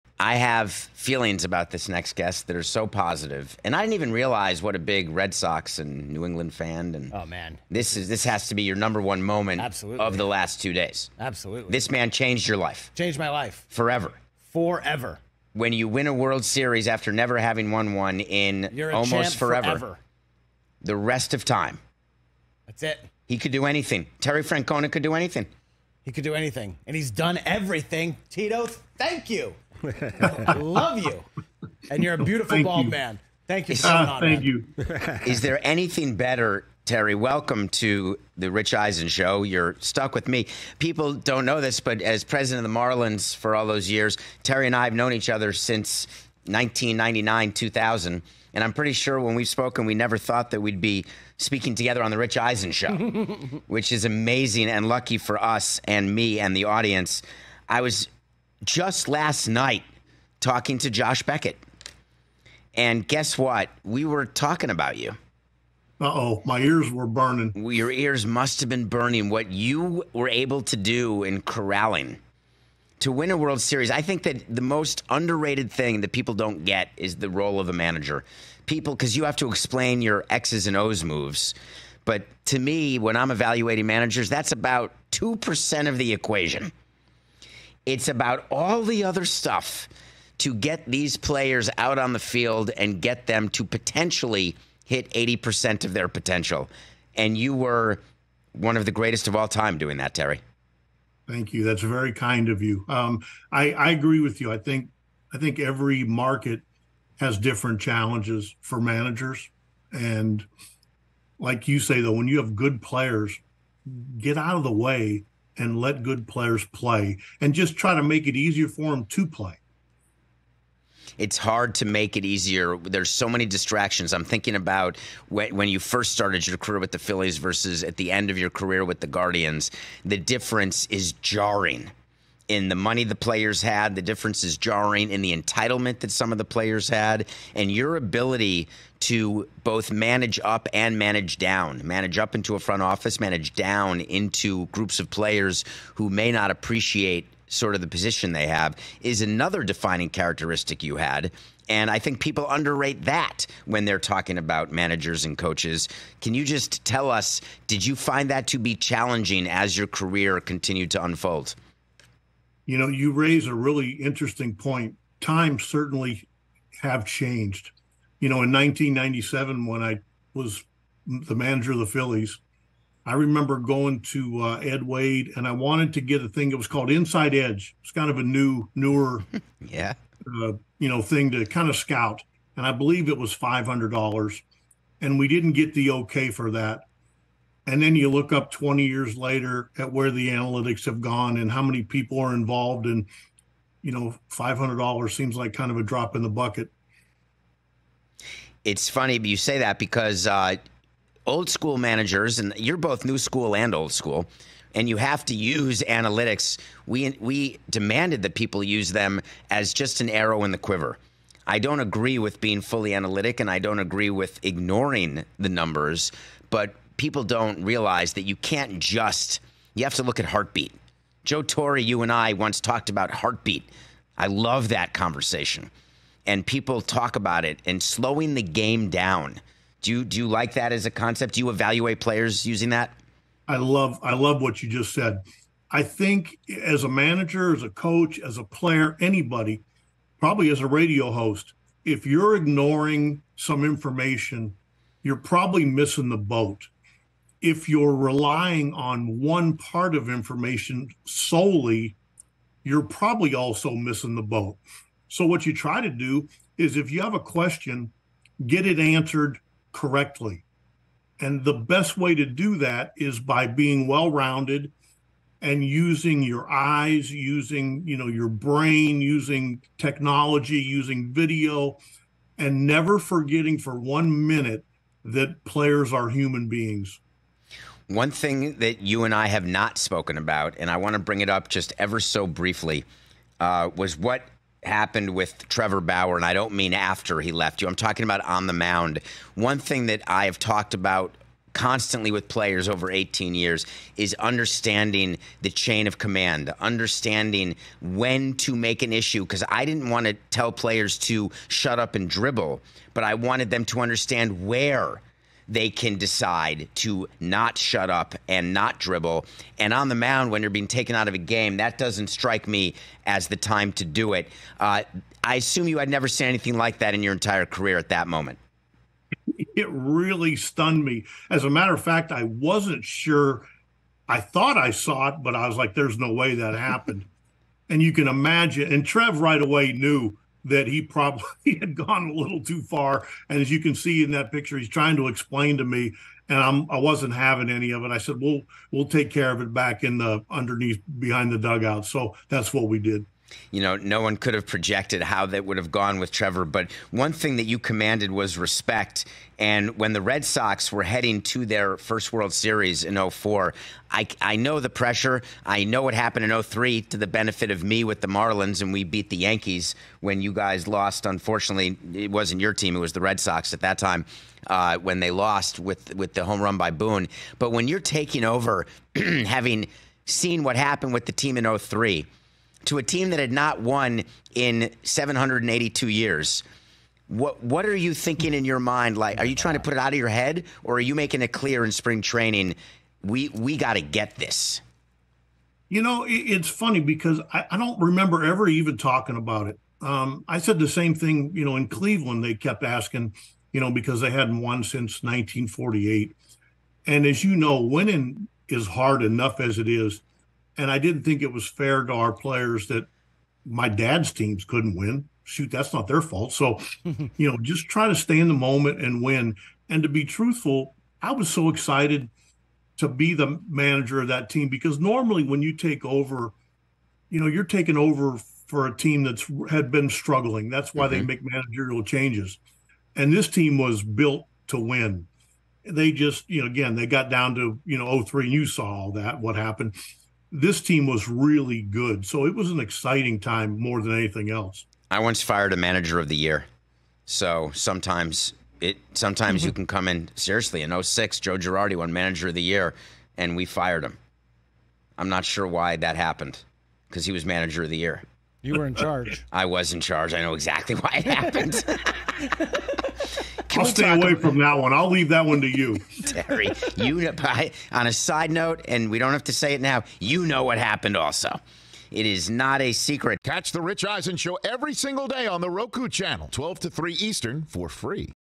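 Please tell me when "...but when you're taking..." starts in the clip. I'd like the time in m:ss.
6:07.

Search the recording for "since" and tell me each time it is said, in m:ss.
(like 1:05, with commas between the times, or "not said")
0:45, 6:34.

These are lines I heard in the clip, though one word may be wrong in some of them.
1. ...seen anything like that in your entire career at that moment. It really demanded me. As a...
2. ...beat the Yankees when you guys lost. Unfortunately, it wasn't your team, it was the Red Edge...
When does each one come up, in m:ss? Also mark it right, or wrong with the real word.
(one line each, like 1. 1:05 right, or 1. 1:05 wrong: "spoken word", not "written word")
1. 5:16 wrong: "stunned", not "demanded"
2. 5:58 wrong: "Sox", not "Edge".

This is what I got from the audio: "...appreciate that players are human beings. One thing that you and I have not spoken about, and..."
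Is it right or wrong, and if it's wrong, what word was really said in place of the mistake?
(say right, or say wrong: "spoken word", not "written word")
wrong: "minute", not "appreciate".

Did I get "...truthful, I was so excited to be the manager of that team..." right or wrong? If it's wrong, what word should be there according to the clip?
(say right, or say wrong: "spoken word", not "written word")
right.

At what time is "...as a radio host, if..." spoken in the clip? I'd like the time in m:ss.
4:00.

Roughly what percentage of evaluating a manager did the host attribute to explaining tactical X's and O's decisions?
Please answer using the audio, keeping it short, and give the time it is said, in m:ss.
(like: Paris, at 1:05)
2%, at 1:25.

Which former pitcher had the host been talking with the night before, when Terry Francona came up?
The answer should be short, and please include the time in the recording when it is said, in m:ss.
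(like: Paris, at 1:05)
Josh Beckett, at 1:00.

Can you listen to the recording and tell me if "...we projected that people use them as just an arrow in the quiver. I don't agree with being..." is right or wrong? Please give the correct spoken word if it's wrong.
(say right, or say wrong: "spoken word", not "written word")
wrong: "demanded", not "projected".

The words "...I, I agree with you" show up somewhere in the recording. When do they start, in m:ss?
1:43.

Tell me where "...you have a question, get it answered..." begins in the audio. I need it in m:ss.
4:16.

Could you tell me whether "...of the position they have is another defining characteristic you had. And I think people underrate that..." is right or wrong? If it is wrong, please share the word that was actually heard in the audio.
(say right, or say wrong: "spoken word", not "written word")
right.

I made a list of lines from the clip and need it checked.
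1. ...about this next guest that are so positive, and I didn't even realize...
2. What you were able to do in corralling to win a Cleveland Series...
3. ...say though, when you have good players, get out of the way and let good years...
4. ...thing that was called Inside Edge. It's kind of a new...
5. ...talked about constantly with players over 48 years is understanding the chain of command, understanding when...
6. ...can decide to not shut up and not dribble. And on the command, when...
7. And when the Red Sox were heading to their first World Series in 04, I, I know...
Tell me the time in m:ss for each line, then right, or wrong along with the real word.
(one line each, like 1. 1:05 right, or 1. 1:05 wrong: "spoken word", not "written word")
1. 0:01 right
2. 1:09 wrong: "World", not "Cleveland"
3. 1:51 wrong: "players", not "years"
4. 2:56 right
5. 4:50 wrong: "18", not "48"
6. 5:05 wrong: "mound", not "command"
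7. 5:49 right.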